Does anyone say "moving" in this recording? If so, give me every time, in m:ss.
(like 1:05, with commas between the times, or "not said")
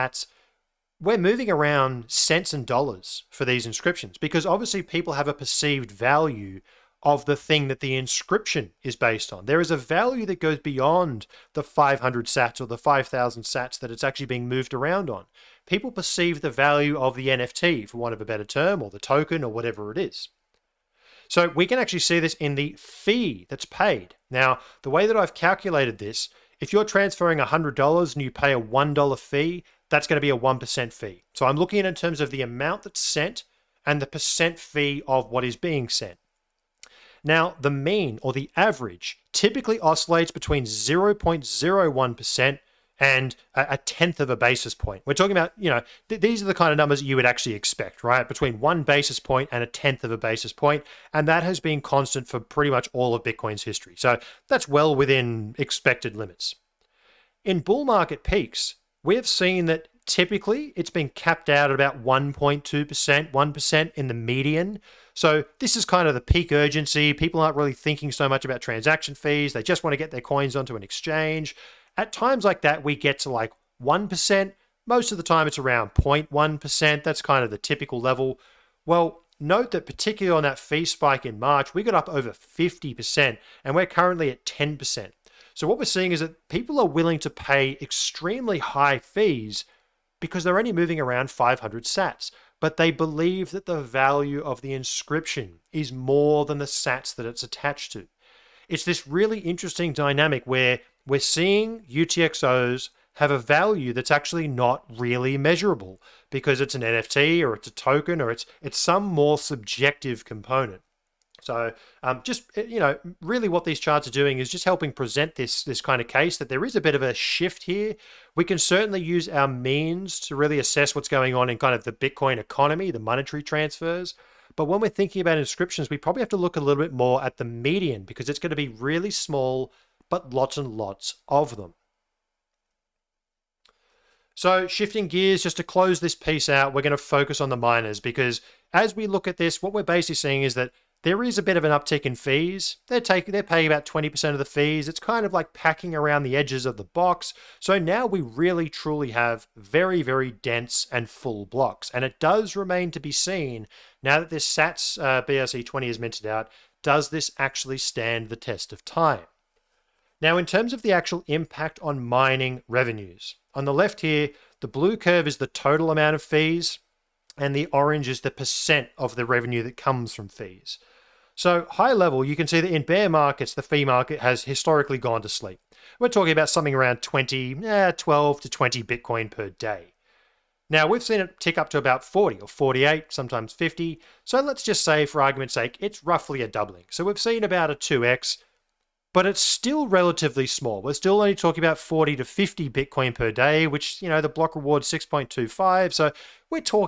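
0:01, 1:30.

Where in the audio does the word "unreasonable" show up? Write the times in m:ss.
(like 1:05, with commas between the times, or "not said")
not said.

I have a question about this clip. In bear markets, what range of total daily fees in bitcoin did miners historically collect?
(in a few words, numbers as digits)
12 to 20.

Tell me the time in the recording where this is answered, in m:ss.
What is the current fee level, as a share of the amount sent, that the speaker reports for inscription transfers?
1:24.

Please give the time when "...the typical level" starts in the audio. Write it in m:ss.
1:17.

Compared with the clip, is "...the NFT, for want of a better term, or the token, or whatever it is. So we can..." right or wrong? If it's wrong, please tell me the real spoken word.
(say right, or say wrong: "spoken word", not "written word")
right.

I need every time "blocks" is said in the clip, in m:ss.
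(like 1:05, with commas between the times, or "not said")
2:31, 3:14.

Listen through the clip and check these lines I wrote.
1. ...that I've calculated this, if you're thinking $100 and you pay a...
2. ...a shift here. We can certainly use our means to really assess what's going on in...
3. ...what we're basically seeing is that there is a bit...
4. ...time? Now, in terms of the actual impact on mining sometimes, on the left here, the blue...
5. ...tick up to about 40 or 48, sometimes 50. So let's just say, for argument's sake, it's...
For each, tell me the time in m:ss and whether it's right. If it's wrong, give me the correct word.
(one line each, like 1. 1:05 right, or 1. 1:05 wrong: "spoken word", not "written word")
1. 0:25 wrong: "transferring", not "thinking"
2. 1:57 right
3. 2:19 right
4. 2:38 wrong: "revenues", not "sometimes"
5. 3:01 right.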